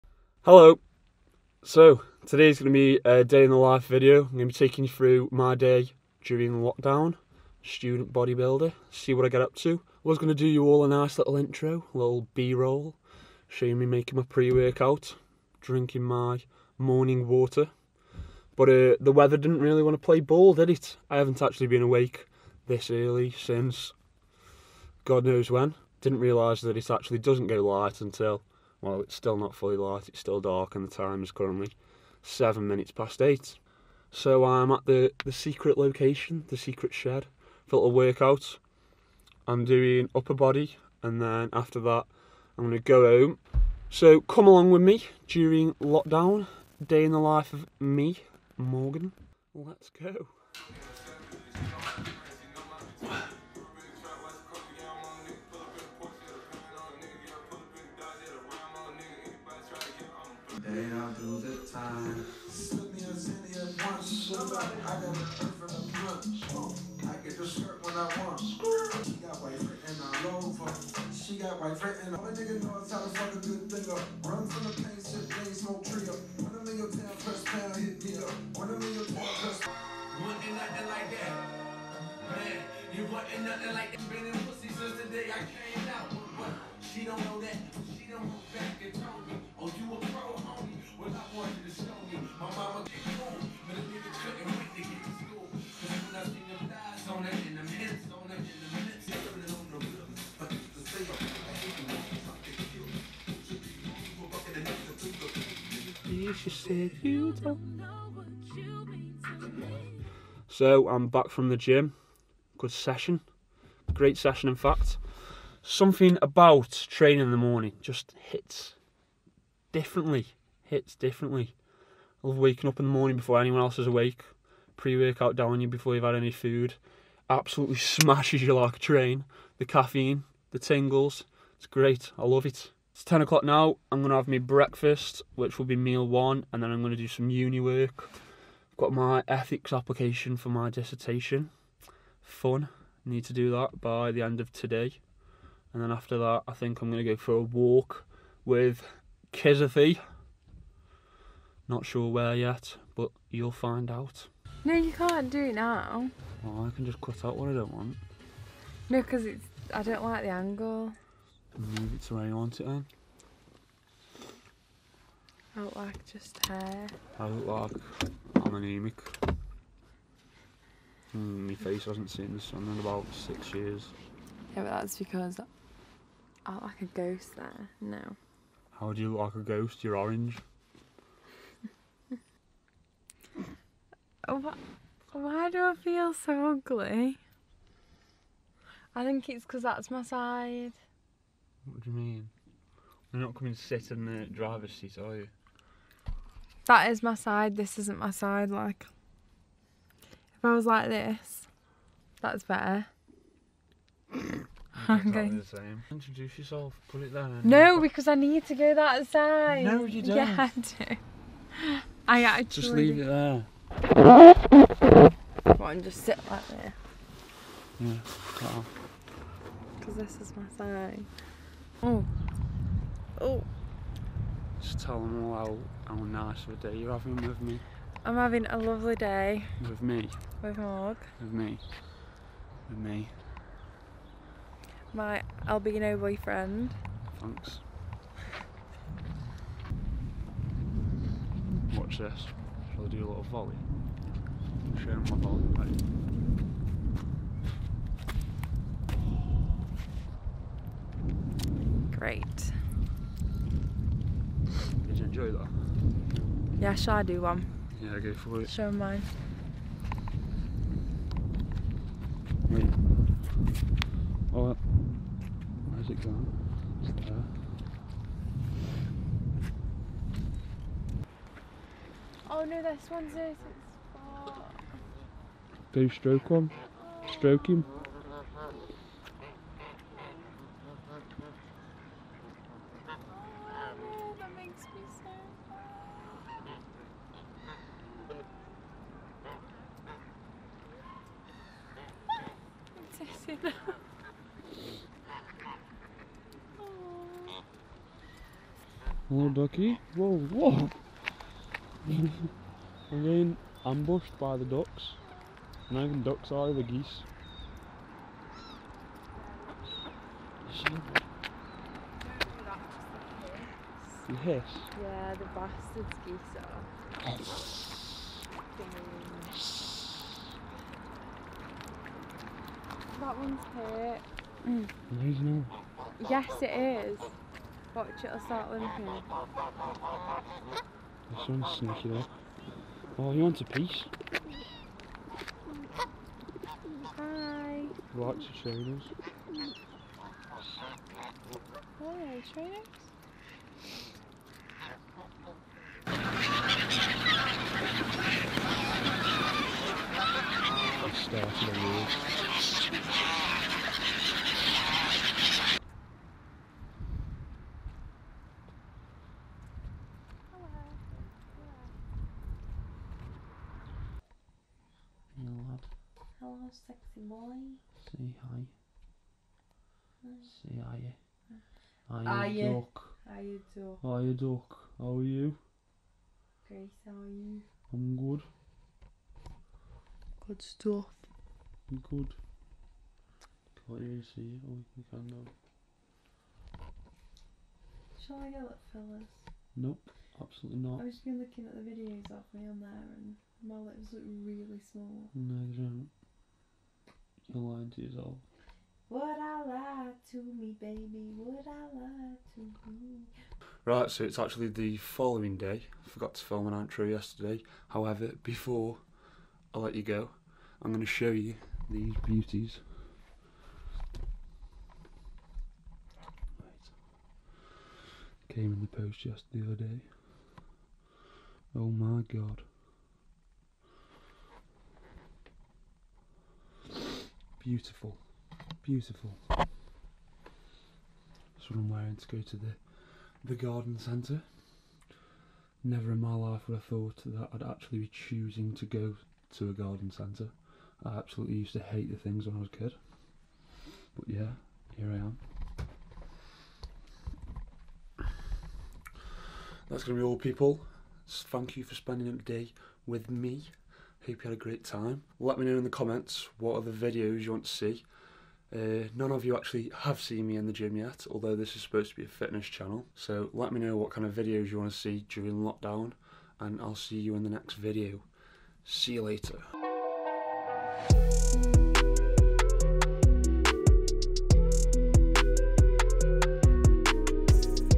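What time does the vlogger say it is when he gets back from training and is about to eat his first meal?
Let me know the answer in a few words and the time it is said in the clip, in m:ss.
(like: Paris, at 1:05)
10 o'clock, at 2:13.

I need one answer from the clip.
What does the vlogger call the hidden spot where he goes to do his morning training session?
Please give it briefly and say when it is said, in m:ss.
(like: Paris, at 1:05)
the secret shed, at 0:36.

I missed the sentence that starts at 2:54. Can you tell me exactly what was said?
Yeah, but that's because I look like a ghost there.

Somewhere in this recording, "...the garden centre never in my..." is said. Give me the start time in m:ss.
7:13.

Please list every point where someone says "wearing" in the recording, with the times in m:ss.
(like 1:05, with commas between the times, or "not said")
7:11.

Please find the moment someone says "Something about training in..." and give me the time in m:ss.
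1:55.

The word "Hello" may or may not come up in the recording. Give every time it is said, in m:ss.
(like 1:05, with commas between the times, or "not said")
0:00, 4:59.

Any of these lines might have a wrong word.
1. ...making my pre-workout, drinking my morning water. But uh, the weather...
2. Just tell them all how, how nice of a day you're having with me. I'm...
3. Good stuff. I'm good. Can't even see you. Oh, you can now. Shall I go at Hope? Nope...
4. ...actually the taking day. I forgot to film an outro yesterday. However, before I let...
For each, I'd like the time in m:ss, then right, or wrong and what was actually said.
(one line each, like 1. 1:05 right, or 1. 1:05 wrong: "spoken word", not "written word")
1. 0:13 right
2. 3:44 right
3. 6:20 wrong: "Phyllis", not "Hope"
4. 6:44 wrong: "following", not "taking".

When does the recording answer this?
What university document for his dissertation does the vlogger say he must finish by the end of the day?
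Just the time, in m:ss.
2:19.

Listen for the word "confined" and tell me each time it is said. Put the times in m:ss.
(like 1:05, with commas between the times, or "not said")
not said.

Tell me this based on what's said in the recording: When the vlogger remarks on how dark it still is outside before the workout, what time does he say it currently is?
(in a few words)
8:07.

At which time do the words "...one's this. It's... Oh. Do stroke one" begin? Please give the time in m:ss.
4:32.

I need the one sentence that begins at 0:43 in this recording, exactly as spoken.
So come along with me during lockdown, day in the life of me, Morgan.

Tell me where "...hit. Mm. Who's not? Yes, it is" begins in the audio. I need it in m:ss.
5:23.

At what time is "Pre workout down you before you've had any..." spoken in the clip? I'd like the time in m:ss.
2:04.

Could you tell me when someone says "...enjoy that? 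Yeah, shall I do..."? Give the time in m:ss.
4:15.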